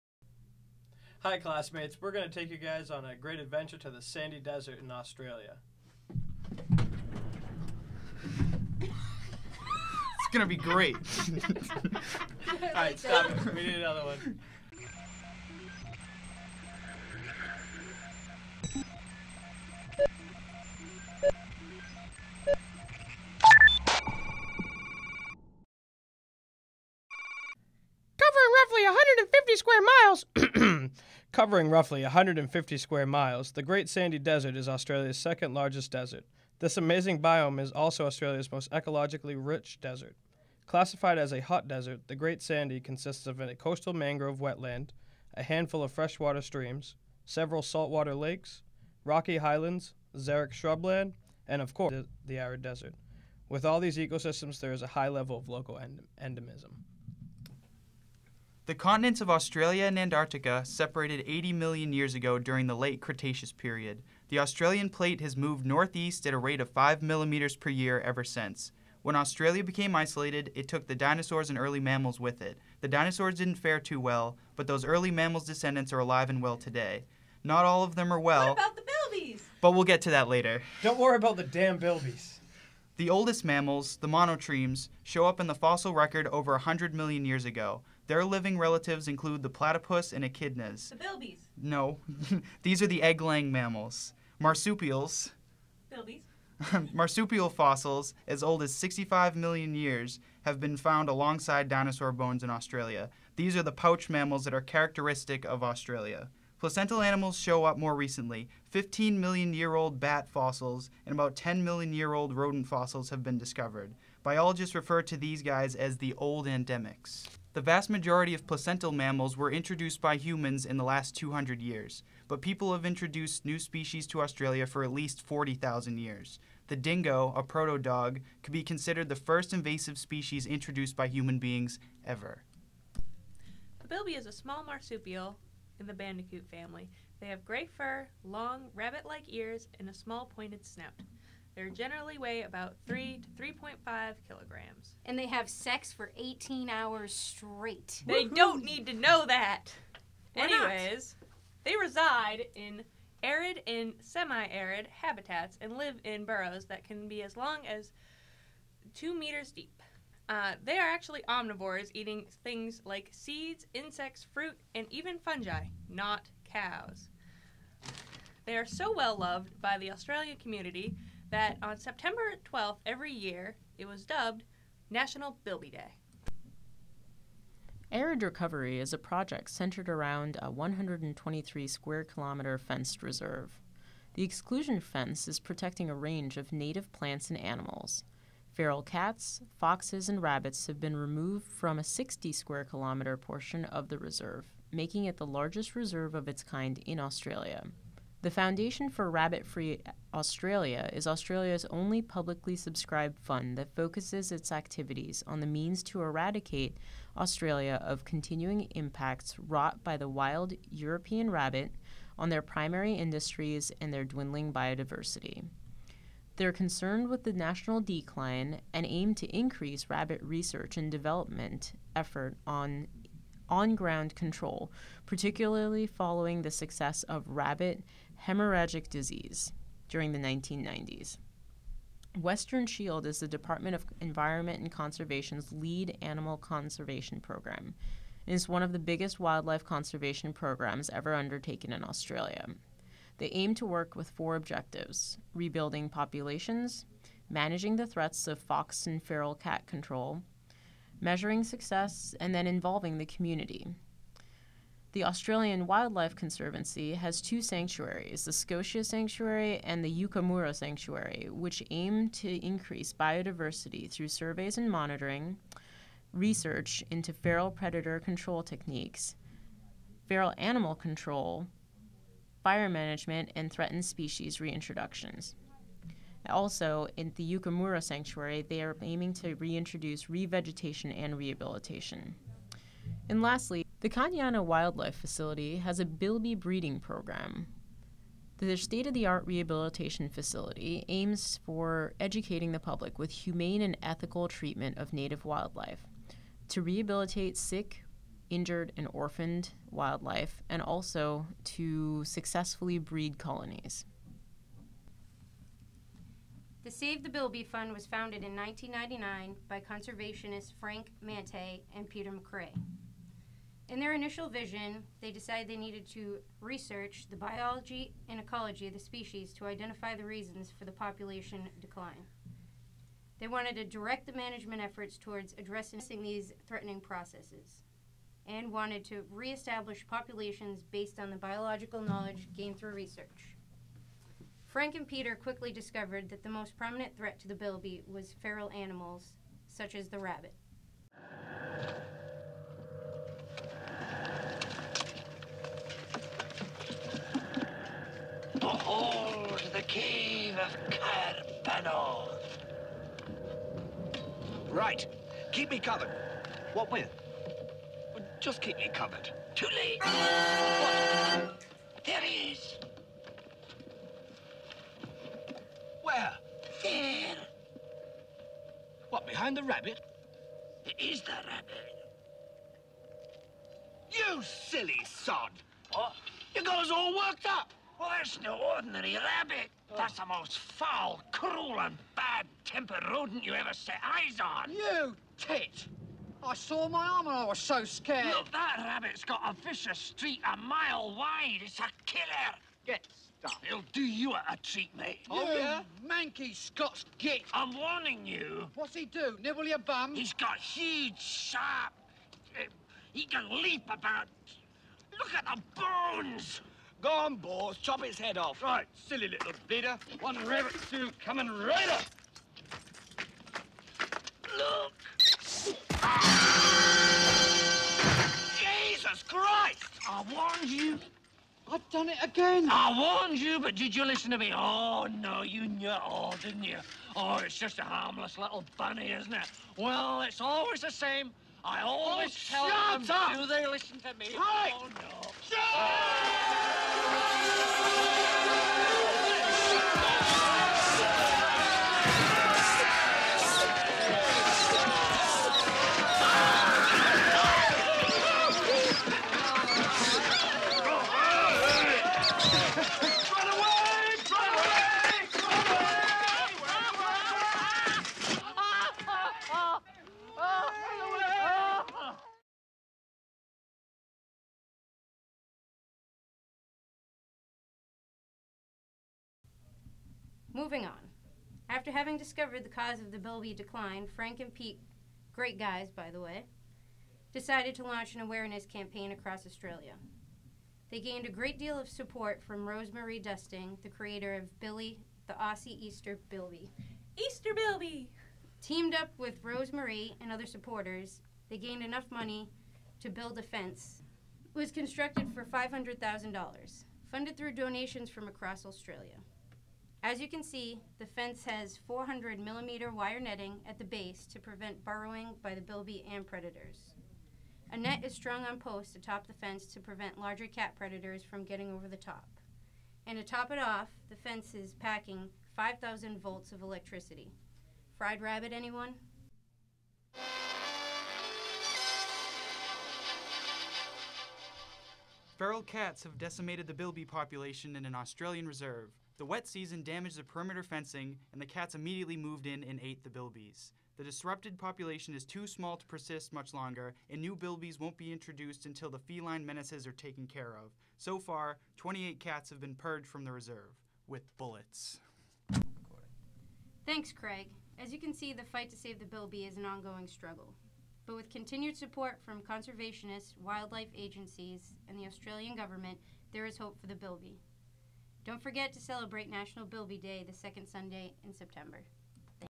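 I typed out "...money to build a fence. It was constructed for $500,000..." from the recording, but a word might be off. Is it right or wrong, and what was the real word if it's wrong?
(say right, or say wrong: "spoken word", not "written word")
right.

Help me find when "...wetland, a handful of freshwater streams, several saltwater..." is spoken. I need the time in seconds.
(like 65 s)
44 s.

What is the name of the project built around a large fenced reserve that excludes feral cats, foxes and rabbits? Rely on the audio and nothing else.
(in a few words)
Arid Recovery.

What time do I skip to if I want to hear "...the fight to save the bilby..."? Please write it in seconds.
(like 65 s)
548 s.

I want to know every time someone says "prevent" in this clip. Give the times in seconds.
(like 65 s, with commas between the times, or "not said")
504 s, 509 s.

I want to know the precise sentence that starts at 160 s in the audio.
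Uh, they are actually omnivores, eating things like seeds, insects, fruit, and even fungi, not cows.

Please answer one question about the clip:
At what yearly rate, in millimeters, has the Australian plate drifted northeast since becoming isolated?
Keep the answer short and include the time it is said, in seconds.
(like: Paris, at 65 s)
5 millimeters per year, at 66 s.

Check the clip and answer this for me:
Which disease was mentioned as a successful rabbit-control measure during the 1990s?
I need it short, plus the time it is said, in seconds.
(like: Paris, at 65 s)
rabbit hemorrhagic disease, at 227 s.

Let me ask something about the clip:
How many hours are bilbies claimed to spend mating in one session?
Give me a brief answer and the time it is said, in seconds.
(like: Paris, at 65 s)
18 hours, at 146 s.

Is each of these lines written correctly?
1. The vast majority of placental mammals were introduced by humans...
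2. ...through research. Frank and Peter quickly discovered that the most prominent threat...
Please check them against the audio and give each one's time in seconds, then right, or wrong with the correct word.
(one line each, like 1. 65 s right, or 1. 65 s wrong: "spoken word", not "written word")
1. 117 s right
2. 332 s right.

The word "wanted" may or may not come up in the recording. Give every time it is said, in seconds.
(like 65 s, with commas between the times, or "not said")
323 s, 328 s.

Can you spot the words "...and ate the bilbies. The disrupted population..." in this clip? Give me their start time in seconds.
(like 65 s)
532 s.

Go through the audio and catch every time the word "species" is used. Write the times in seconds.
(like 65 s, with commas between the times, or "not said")
123 s, 129 s, 273 s, 318 s.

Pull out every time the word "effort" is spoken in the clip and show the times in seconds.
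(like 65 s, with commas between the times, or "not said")
221 s, 324 s.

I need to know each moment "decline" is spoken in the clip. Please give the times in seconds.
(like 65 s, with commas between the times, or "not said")
217 s, 321 s, 473 s.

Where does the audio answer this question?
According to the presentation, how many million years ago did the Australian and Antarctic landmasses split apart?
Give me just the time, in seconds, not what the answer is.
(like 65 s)
61 s.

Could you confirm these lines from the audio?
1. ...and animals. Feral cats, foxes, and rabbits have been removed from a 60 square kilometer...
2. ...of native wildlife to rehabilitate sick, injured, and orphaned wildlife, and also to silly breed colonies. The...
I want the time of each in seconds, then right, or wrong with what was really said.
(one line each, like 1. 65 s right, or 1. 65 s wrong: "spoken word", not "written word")
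1. 187 s right
2. 294 s wrong: "successfully", not "silly".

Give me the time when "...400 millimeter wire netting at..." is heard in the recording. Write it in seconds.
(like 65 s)
501 s.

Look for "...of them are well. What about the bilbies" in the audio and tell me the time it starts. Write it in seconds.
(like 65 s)
77 s.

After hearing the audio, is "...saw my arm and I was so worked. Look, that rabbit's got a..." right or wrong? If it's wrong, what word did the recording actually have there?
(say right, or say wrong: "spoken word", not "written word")
wrong: "scared", not "worked".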